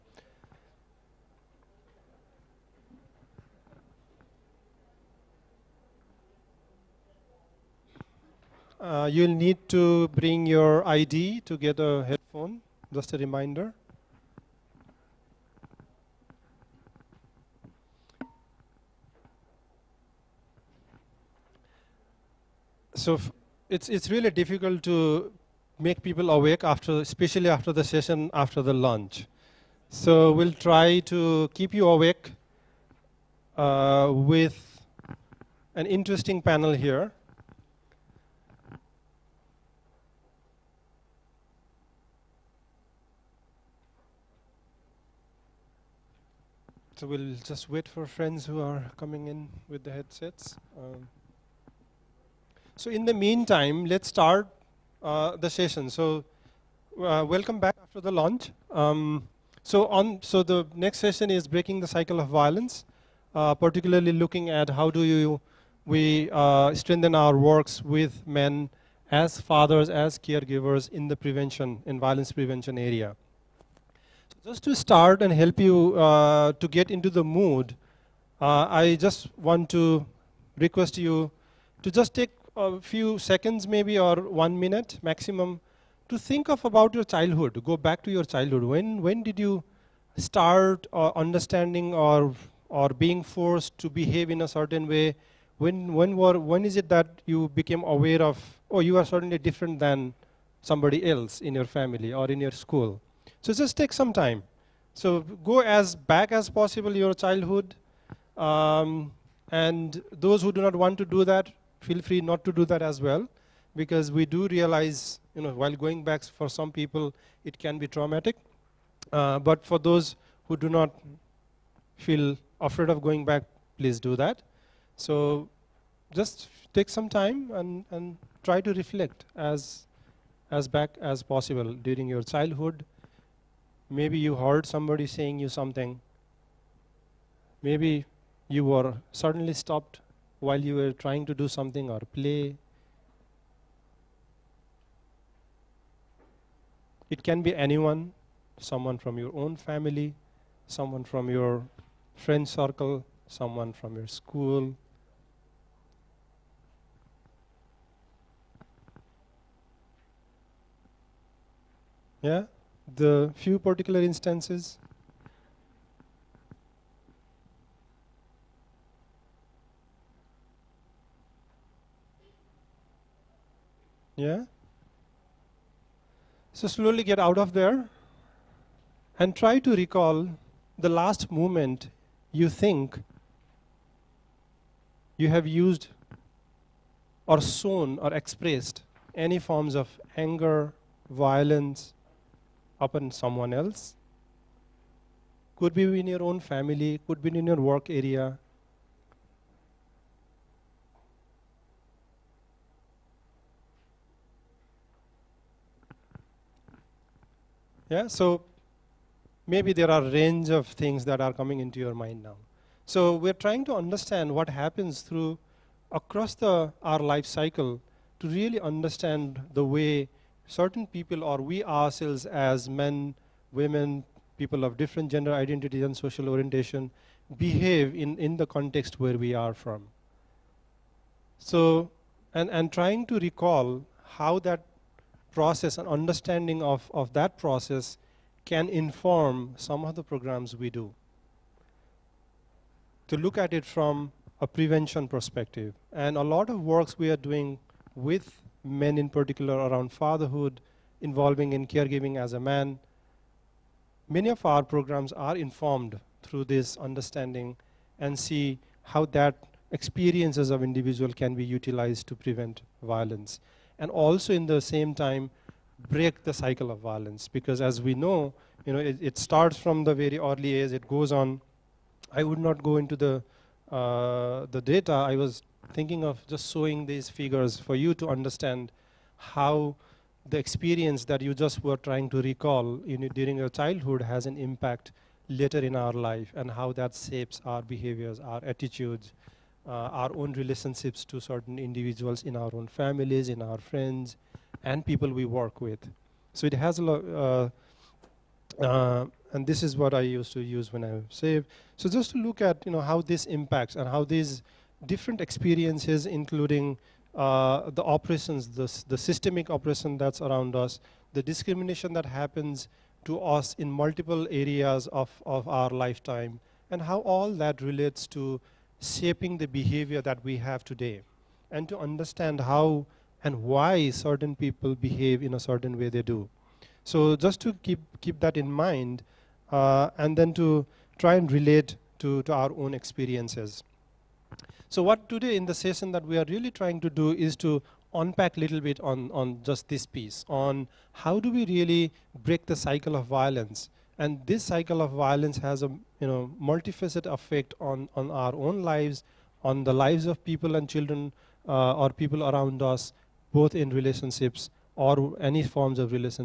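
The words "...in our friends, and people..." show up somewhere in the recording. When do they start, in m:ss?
4:53.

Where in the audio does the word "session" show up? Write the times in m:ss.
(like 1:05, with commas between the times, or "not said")
0:27, 0:55, 1:00, 5:35.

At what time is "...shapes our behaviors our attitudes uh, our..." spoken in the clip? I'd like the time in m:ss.
4:46.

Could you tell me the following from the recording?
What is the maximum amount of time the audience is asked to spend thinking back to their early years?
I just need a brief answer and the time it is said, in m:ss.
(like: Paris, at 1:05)
1 minute, at 1:24.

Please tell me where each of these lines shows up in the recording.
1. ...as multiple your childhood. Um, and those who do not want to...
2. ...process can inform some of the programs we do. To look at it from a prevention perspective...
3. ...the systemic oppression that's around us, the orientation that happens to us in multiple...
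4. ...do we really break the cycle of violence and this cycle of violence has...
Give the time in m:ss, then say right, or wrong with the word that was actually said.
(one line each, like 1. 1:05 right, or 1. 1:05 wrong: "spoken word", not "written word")
1. 1:46 wrong: "possible", not "multiple"
2. 3:57 right
3. 5:08 wrong: "discrimination", not "orientation"
4. 5:41 right.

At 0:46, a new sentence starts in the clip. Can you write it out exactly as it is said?
So we'll just wait for friends who are coming in with the headsets.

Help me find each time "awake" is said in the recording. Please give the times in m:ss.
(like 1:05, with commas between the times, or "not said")
0:26, 0:31.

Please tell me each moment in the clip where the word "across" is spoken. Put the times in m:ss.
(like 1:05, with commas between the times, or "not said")
3:35.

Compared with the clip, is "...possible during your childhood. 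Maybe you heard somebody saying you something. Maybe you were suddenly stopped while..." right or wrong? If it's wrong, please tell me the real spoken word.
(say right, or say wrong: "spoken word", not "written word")
right.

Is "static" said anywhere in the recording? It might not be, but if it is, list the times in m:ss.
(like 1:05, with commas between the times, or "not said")
not said.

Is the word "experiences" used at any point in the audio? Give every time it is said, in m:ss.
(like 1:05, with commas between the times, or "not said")
4:19, 4:40, 5:05, 5:32.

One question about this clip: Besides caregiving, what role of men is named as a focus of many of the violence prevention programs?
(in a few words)
fatherhood.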